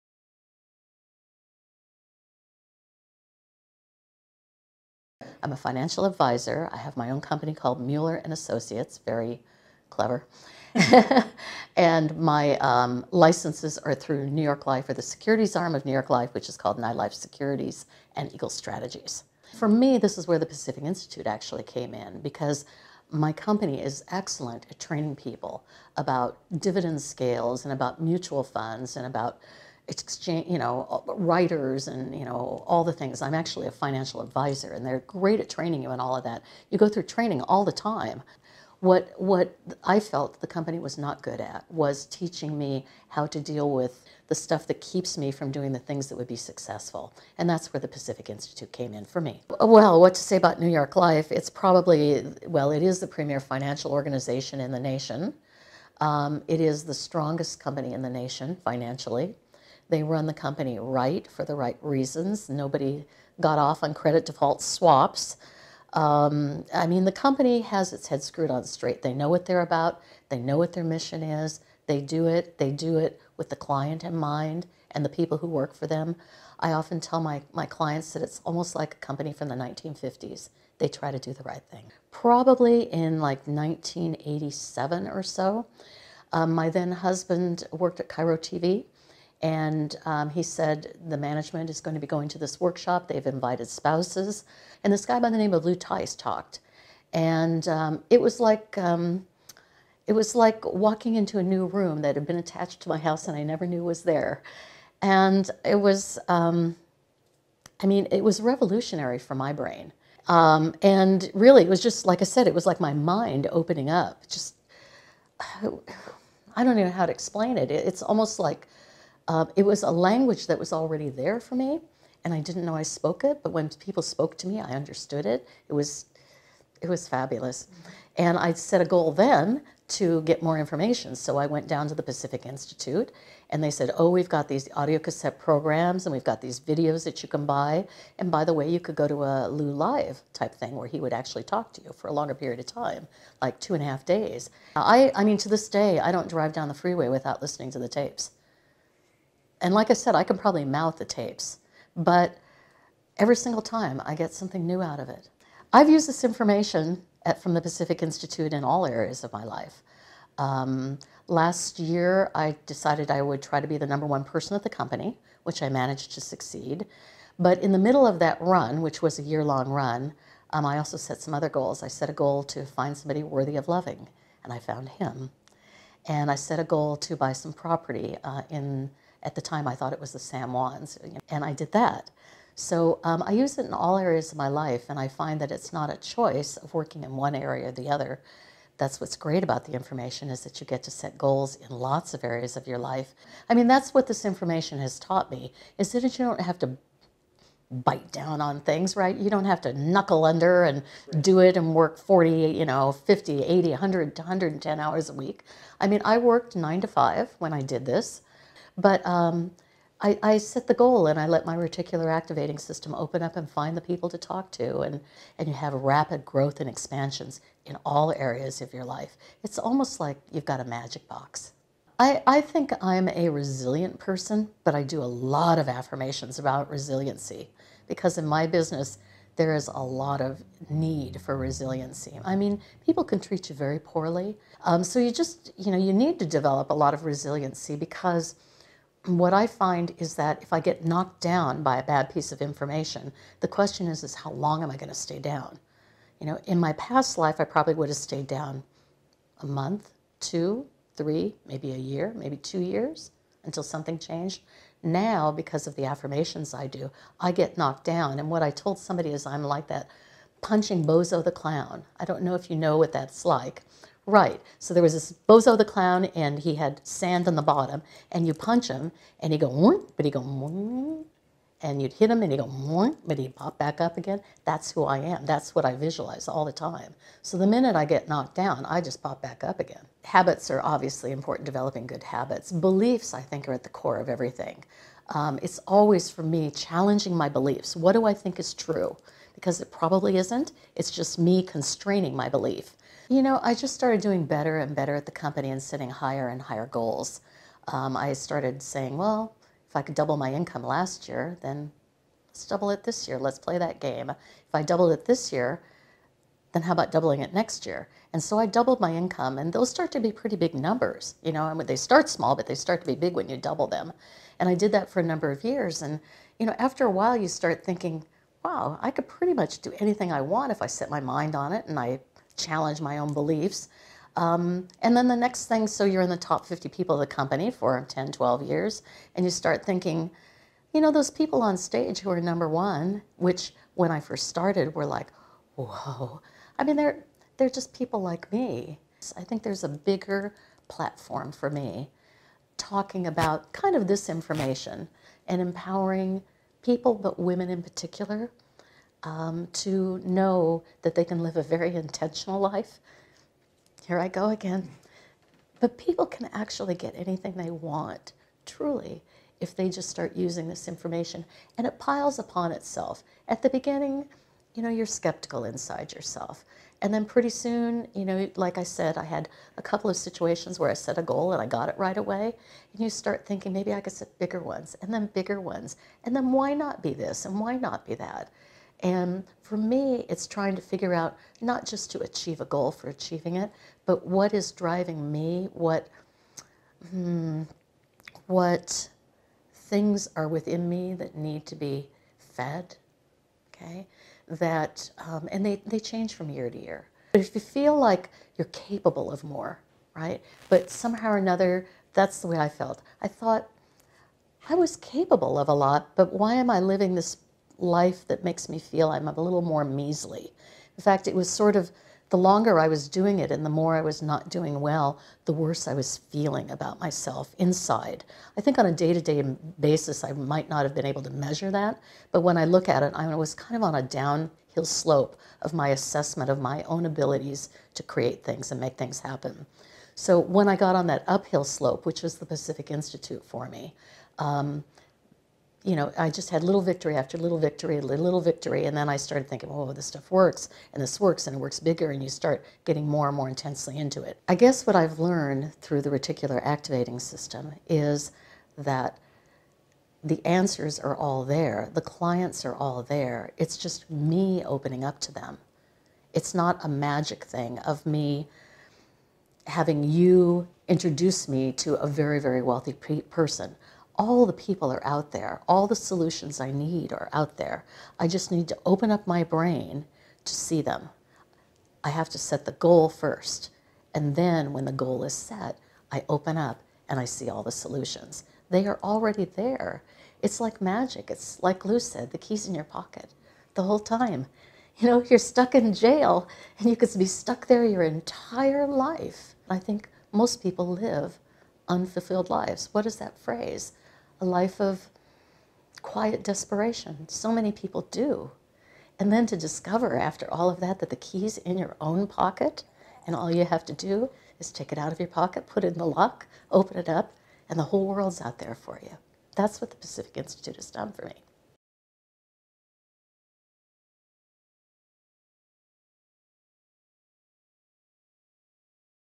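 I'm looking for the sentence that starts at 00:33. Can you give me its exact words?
I'm actually a financial advisor and they're great at training you and all of that.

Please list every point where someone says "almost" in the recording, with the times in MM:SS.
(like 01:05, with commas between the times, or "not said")
01:18, 01:58, 03:39.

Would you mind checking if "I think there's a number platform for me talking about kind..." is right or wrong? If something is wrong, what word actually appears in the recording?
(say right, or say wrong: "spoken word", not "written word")
wrong: "bigger", not "number".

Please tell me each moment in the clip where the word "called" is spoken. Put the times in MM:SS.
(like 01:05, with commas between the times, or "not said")
00:07, 00:16.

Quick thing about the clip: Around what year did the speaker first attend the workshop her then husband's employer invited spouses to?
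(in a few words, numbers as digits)
1987.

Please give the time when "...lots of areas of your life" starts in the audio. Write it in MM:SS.
03:11.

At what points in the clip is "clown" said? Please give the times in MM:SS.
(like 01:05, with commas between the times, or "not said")
04:21, 04:25.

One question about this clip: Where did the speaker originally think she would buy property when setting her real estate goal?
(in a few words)
the San Juans.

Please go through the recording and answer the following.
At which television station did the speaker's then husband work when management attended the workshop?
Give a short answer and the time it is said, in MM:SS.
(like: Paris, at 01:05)
KIRO TV, at 01:28.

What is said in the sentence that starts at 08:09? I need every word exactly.
I think most people live unfulfilled lives.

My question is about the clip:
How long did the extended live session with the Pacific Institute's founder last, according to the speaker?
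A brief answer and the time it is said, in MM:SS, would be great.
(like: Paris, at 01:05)
two and a half days, at 02:23.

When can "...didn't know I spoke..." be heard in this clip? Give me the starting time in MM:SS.
02:02.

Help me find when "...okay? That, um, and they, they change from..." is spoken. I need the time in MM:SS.
06:33.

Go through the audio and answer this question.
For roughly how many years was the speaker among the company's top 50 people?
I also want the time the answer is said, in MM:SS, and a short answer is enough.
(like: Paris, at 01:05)
10, 12 years, at 05:27.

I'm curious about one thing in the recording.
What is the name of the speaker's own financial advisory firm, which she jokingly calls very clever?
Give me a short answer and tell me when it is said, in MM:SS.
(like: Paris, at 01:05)
Mueller and Associates, at 00:07.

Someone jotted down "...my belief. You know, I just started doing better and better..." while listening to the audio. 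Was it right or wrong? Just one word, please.
right.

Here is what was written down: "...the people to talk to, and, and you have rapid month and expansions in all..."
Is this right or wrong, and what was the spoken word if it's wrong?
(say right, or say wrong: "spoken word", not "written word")
wrong: "growth", not "month".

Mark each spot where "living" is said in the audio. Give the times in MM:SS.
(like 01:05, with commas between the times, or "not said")
06:46.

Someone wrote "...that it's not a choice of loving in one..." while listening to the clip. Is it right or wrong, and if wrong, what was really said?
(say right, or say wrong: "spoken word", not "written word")
wrong: "working", not "loving".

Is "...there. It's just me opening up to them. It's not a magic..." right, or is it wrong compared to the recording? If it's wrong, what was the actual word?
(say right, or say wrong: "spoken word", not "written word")
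right.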